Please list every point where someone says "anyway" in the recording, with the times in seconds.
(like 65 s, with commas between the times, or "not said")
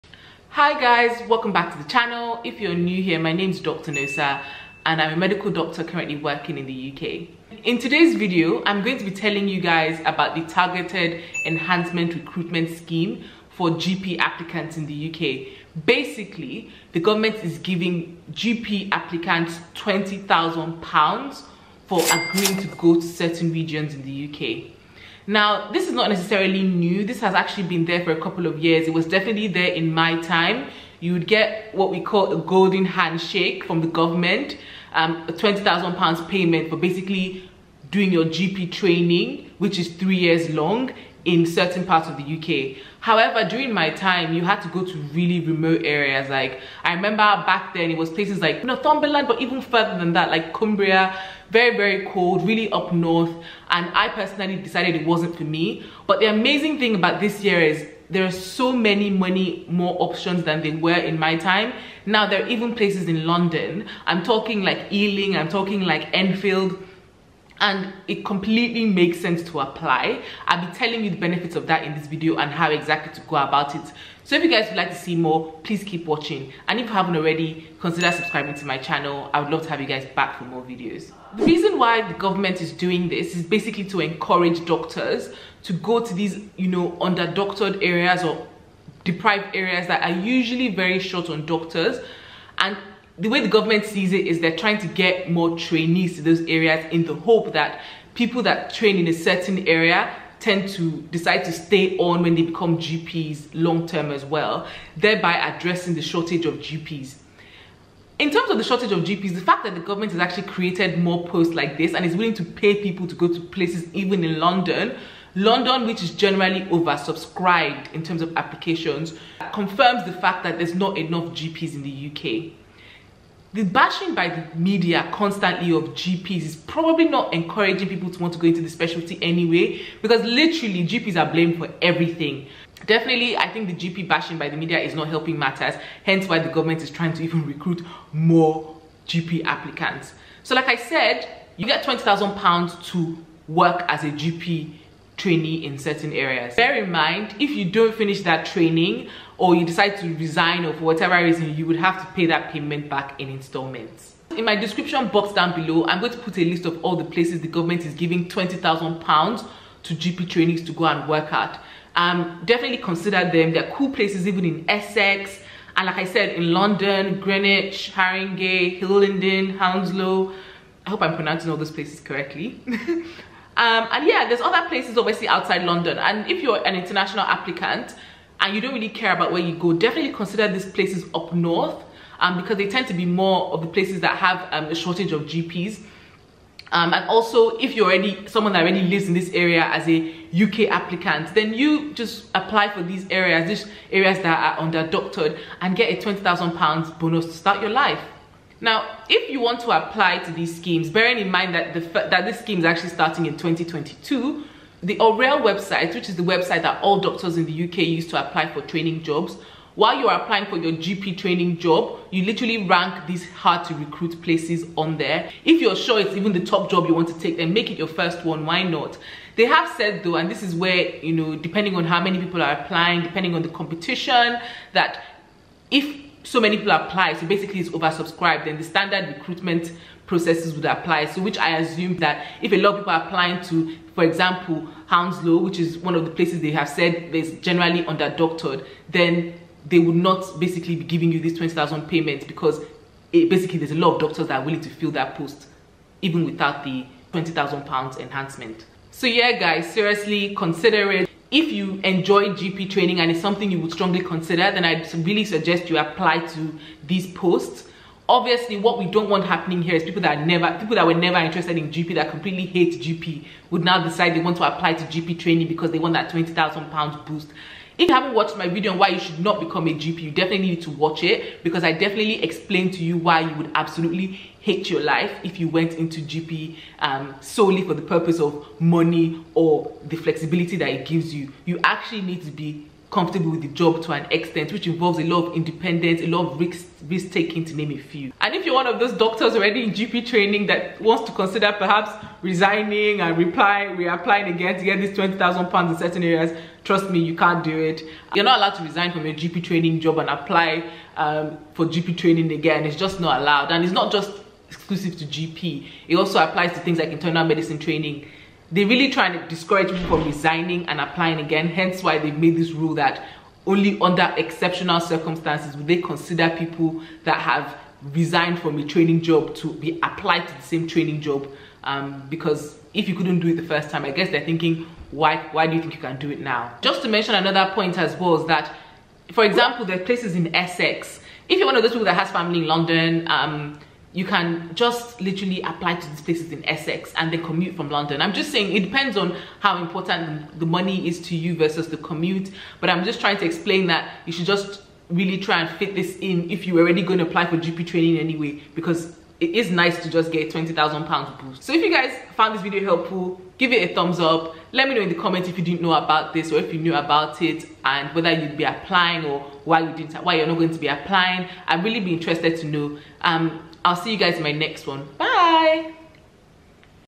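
129 s, 347 s.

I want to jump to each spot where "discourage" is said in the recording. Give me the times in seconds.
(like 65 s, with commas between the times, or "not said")
309 s.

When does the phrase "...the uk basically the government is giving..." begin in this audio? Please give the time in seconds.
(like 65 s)
14 s.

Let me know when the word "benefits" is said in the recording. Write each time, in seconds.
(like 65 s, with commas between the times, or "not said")
71 s.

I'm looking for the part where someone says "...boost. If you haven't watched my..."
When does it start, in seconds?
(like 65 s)
267 s.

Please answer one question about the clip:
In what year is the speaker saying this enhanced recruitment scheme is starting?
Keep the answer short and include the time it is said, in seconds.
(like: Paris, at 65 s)
2022, at 203 s.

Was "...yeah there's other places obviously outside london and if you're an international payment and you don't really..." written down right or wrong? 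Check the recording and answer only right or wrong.
wrong.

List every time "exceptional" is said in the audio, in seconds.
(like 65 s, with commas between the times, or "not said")
314 s.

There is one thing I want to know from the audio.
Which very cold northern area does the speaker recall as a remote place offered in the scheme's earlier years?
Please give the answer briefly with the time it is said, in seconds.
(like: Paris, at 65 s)
Cumbria, at 50 s.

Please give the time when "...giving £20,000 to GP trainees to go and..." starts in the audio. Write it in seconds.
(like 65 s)
157 s.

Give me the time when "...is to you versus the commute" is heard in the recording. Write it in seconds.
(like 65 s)
340 s.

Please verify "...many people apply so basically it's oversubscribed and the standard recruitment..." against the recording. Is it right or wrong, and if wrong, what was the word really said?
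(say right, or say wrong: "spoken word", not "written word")
right.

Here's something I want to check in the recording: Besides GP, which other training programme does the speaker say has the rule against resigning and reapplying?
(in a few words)
Internal medicine training.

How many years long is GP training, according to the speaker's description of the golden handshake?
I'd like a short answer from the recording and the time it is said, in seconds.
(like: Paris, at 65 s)
3, at 39 s.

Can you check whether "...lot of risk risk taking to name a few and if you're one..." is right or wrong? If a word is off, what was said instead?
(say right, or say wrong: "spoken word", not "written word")
right.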